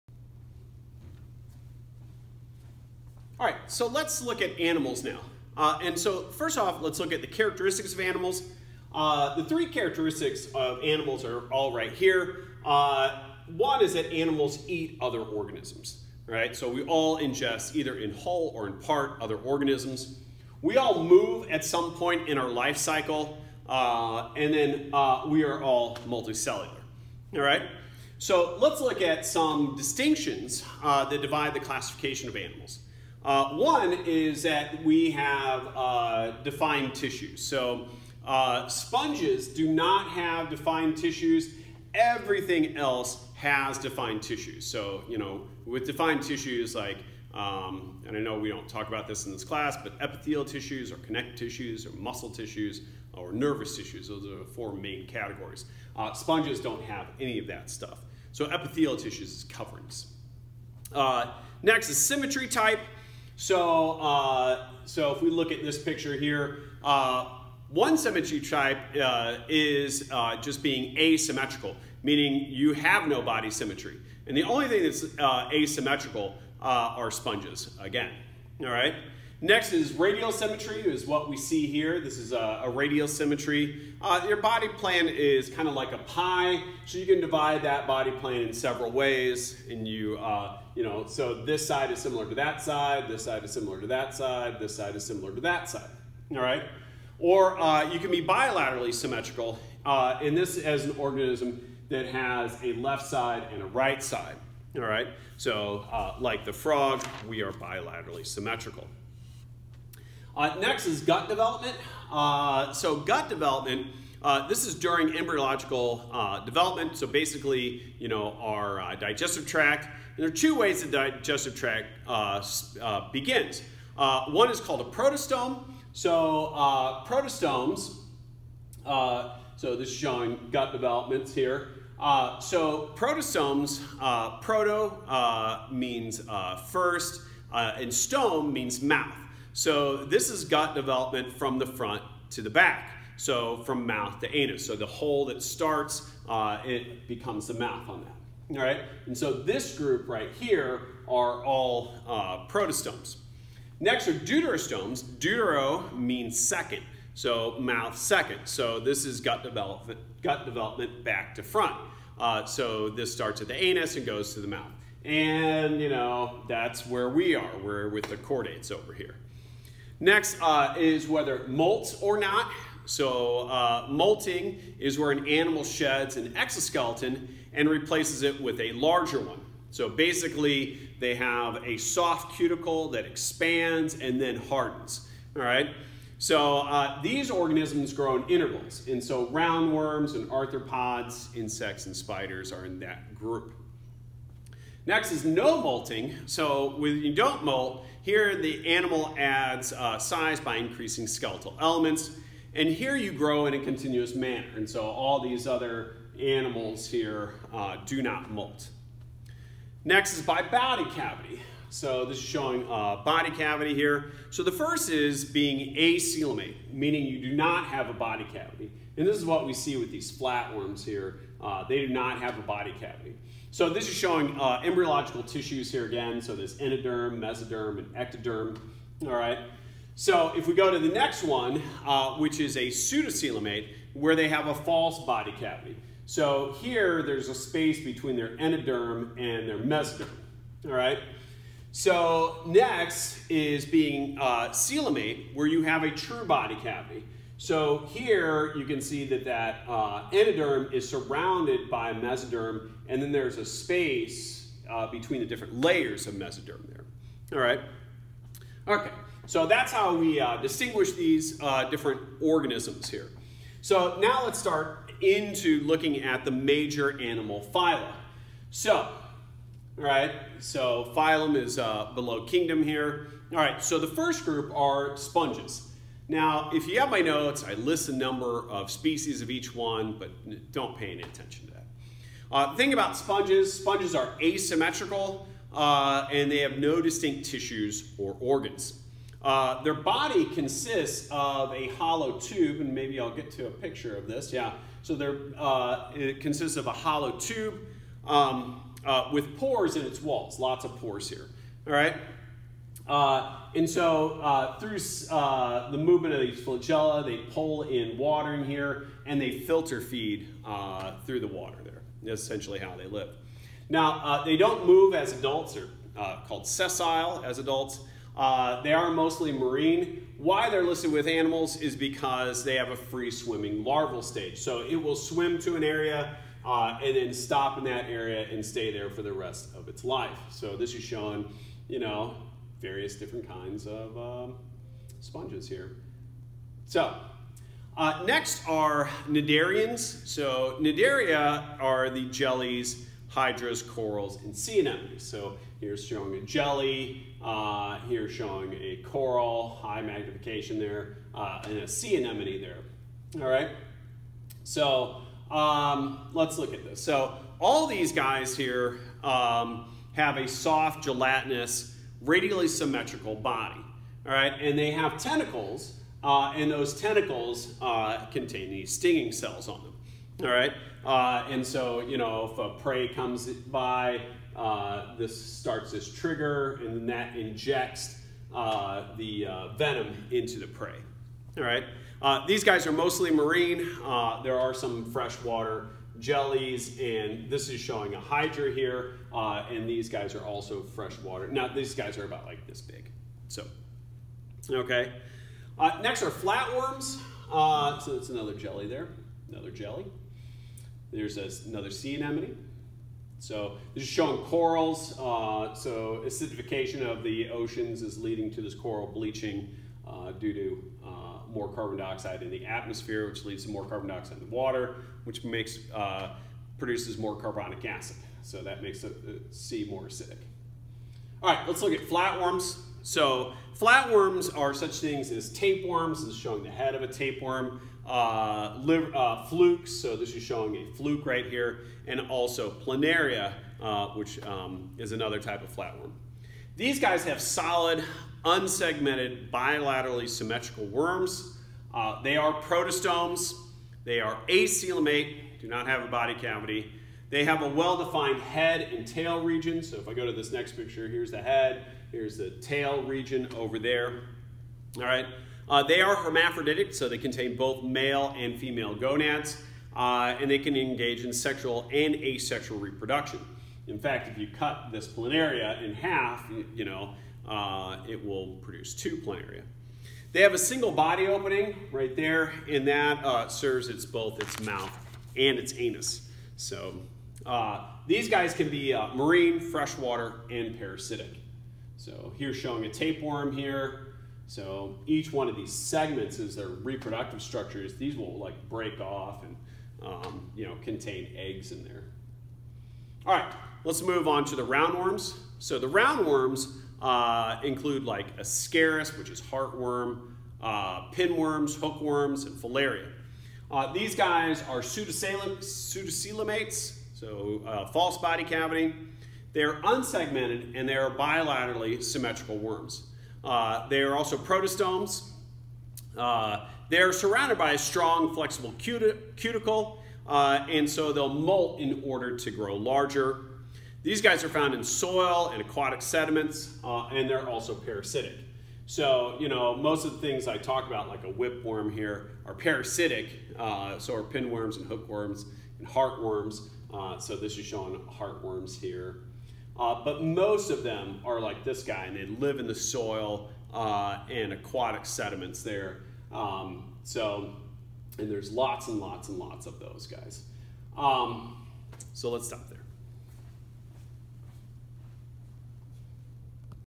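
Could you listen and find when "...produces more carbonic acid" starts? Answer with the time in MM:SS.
06:56.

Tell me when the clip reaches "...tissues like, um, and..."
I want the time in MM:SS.
00:46.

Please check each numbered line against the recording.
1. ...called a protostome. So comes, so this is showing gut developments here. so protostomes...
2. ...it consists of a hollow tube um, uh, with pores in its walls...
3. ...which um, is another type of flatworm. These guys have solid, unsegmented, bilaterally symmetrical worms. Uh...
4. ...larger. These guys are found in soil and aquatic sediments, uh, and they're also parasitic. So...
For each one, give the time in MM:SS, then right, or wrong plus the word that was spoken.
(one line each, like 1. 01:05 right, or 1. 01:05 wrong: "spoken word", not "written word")
1. 02:04 wrong: "protostomes", not "comes"
2. 04:55 right
3. 07:13 right
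4. 08:42 right.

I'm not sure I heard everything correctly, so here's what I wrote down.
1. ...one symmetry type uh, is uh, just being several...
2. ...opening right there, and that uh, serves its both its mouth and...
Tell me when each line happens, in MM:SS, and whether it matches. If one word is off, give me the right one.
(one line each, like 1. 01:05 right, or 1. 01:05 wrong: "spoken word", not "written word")
1. 01:07 wrong: "asymmetrical", not "several"
2. 07:51 right.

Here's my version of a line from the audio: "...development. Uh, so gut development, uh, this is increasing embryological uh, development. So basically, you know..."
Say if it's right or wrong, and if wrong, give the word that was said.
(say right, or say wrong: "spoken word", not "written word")
wrong: "during", not "increasing".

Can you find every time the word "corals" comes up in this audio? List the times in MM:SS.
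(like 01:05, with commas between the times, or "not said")
05:43, 05:48, 06:44, 06:48.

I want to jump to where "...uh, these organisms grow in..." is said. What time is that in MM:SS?
03:06.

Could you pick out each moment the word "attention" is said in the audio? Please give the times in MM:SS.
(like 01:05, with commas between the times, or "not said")
04:41.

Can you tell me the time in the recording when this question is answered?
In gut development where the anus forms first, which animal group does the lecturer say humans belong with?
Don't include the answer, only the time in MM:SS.
02:47.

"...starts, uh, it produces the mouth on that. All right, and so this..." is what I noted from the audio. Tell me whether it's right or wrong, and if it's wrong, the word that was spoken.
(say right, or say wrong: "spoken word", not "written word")
wrong: "becomes", not "produces".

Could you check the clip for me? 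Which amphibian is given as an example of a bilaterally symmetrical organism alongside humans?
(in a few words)
the frog.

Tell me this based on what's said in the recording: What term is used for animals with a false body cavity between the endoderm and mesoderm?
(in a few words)
pseudocoelomate.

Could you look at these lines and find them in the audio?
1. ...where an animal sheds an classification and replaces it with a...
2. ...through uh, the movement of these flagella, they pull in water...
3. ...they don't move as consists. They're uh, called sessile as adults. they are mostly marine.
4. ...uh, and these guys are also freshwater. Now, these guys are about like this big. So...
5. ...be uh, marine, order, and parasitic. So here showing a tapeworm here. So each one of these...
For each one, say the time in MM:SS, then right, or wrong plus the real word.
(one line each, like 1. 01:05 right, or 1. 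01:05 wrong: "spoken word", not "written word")
1. 02:54 wrong: "exoskeleton", not "classification"
2. 05:04 right
3. 05:14 wrong: "adults", not "consists"
4. 06:29 right
5. 07:58 wrong: "freshwater", not "order".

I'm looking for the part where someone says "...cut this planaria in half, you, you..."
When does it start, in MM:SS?
07:44.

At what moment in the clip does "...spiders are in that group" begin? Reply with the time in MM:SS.
03:11.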